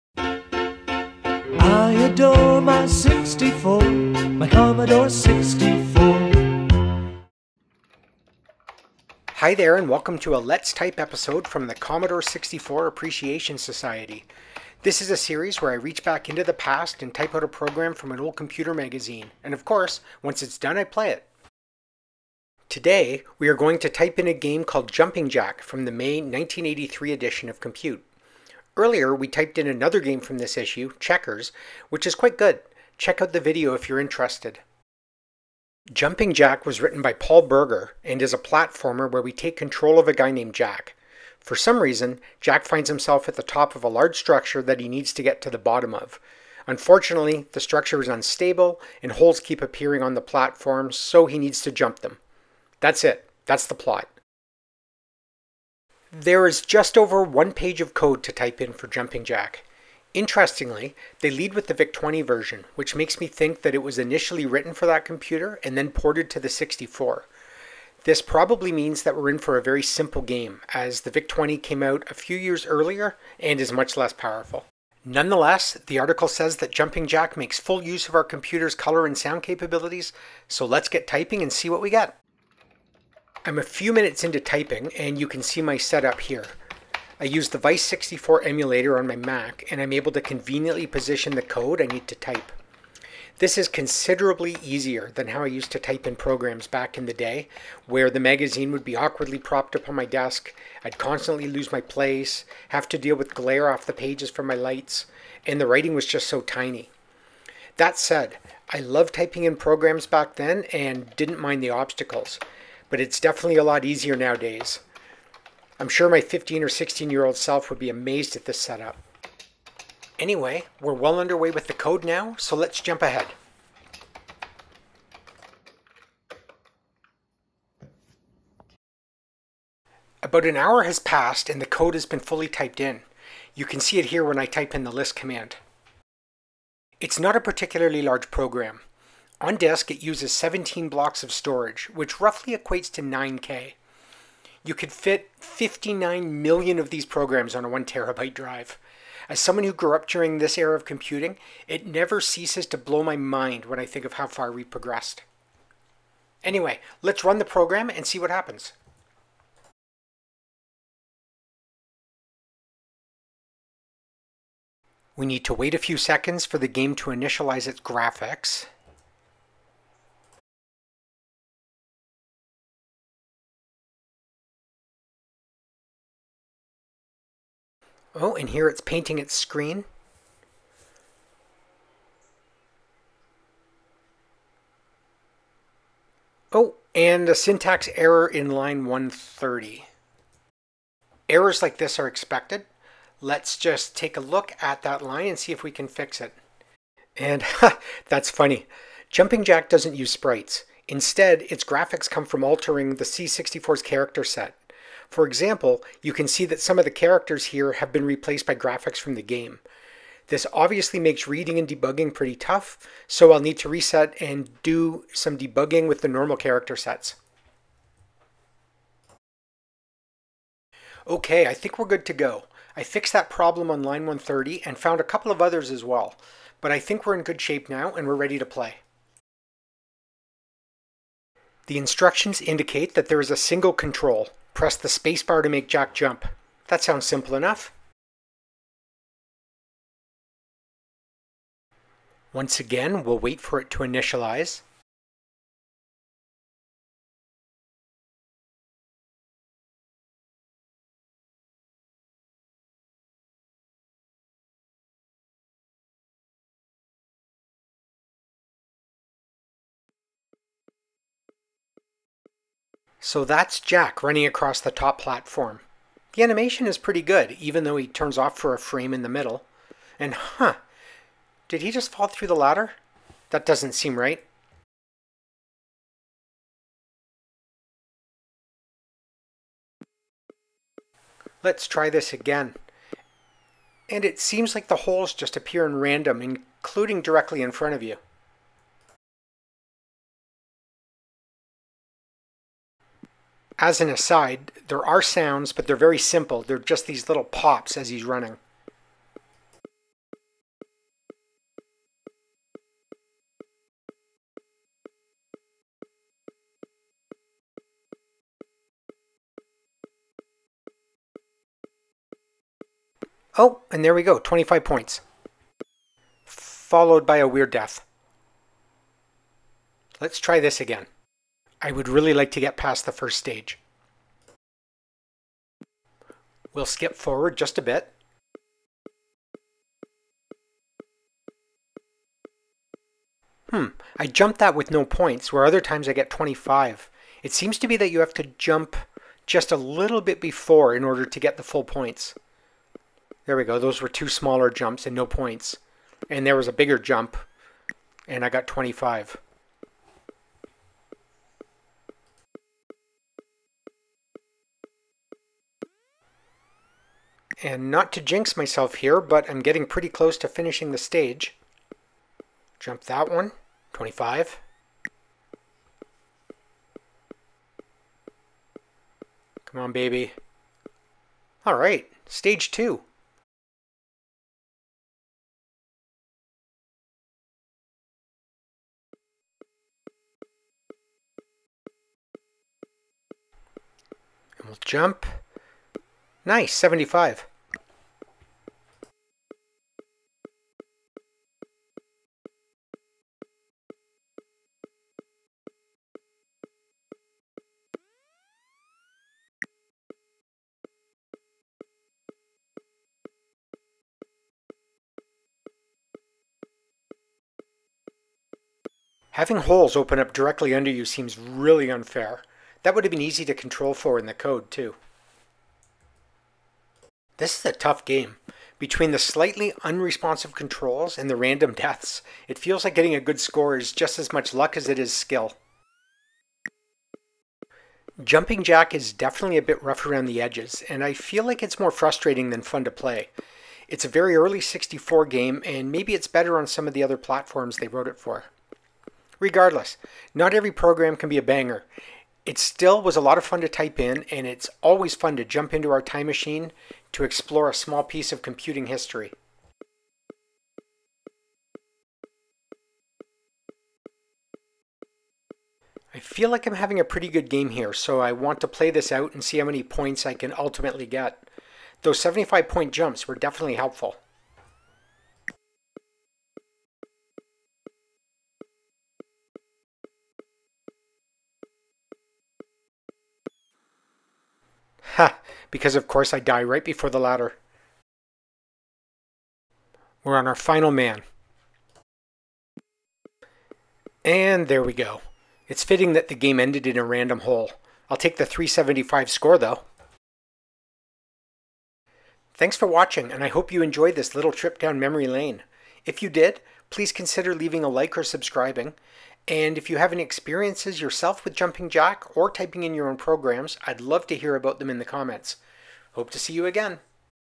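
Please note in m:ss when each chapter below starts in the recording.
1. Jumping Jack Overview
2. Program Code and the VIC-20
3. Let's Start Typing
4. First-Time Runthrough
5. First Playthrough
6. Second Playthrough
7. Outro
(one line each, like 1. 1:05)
1. 0:35
2. 0:55
3. 1:22
4. 2:09
5. 3:39
6. 5:18
7. 8:11.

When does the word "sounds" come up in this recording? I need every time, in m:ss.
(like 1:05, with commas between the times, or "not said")
1:19, 3:56, 4:55.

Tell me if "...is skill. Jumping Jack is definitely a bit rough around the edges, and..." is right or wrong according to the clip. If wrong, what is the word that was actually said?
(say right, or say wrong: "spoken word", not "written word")
right.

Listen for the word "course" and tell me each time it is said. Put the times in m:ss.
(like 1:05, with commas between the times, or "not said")
0:19, 7:55.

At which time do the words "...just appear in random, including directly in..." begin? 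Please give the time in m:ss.
4:45.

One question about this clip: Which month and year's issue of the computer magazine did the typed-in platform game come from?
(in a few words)
May 1983.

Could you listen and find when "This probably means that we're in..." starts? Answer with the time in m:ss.
1:08.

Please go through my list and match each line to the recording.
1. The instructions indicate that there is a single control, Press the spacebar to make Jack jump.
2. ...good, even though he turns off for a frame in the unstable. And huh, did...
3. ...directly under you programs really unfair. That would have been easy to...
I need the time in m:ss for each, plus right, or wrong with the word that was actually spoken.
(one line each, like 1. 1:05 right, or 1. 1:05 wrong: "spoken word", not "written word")
1. 3:51 right
2. 4:27 wrong: "middle", not "unstable"
3. 6:50 wrong: "seems", not "programs".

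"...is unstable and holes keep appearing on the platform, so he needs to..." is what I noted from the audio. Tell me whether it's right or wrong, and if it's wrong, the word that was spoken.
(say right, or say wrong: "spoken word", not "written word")
right.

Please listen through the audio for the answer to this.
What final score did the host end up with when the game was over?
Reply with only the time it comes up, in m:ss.
8:08.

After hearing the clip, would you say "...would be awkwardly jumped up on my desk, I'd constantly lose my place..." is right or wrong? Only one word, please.
wrong.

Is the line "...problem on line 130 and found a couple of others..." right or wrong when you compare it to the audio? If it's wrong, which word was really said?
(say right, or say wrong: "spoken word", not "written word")
right.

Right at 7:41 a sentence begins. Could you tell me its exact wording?
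Those 75 point jumps were definitely helpful.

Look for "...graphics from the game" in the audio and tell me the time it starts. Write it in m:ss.
3:28.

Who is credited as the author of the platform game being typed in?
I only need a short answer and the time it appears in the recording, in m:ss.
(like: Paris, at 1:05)
Paul Burger, at 0:37.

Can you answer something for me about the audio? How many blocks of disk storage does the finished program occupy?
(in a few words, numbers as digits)
17.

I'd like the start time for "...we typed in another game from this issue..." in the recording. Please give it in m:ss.
0:29.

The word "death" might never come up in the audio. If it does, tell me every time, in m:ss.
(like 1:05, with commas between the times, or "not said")
5:17, 7:01.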